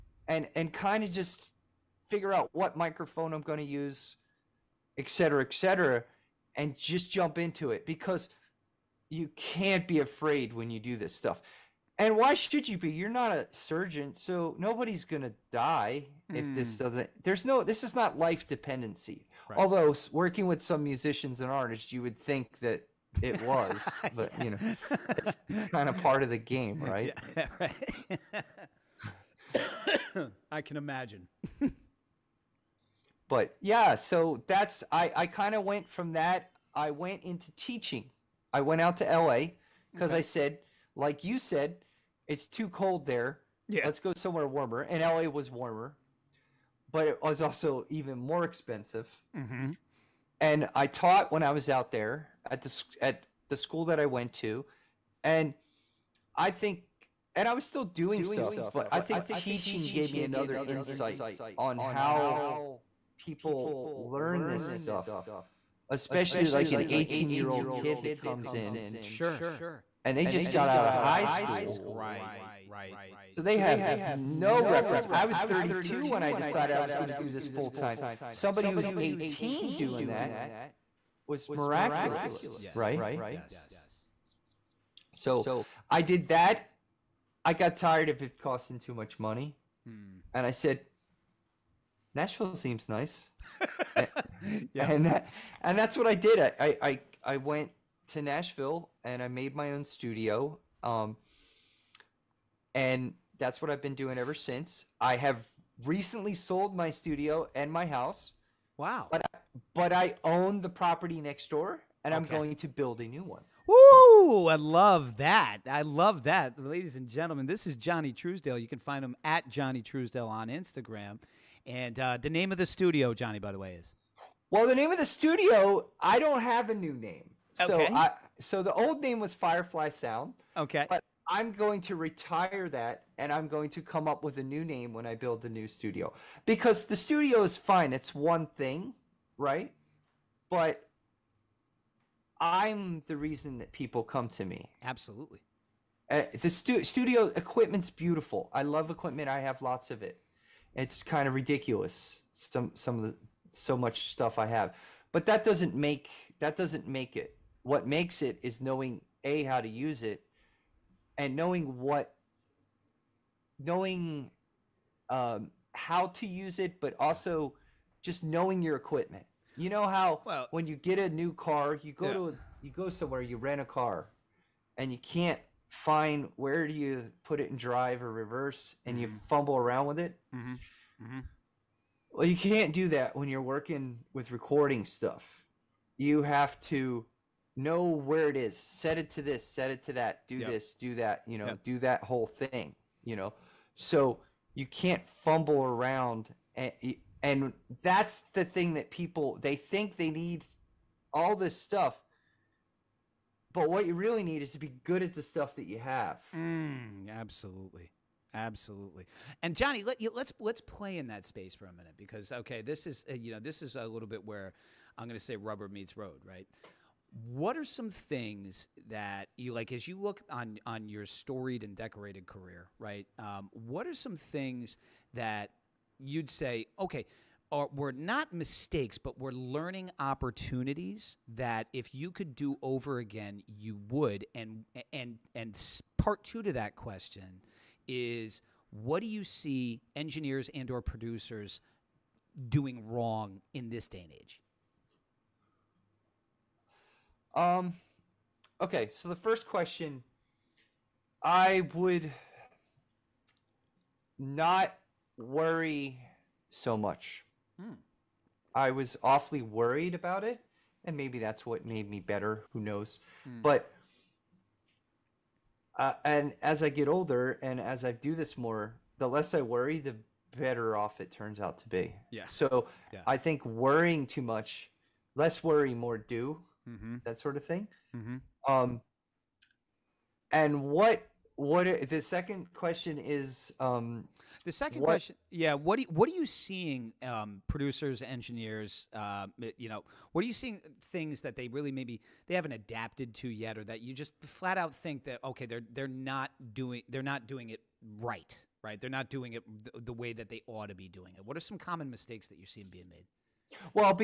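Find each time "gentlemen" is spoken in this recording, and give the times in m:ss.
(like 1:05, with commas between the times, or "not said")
1:57.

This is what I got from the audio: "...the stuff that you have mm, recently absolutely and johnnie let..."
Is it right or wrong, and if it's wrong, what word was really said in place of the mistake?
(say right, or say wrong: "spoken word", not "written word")
wrong: "absolutely", not "recently".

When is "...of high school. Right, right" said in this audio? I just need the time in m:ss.
1:10.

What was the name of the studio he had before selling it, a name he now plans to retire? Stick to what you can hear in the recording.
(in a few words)
Firefly Sound.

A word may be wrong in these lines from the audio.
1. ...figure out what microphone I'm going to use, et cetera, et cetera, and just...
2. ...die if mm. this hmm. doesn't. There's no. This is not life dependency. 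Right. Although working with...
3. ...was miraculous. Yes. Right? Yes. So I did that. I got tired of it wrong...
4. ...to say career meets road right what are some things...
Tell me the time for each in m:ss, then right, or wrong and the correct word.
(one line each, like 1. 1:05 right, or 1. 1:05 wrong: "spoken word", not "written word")
1. 0:02 right
2. 0:15 right
3. 1:21 wrong: "costing", not "wrong"
4. 3:35 wrong: "rubber", not "career".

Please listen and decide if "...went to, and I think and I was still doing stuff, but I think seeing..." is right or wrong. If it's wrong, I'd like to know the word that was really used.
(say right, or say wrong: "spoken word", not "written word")
wrong: "teaching", not "seeing".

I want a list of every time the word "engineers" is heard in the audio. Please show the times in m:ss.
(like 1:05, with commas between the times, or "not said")
3:59, 4:48.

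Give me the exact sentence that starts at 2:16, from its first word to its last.
Because the studio is fine, it's one thing, right?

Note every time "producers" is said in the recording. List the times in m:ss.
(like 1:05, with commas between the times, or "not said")
4:00, 4:47.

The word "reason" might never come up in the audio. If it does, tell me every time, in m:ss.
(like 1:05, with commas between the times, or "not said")
2:23.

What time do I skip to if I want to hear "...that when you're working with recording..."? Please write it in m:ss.
3:02.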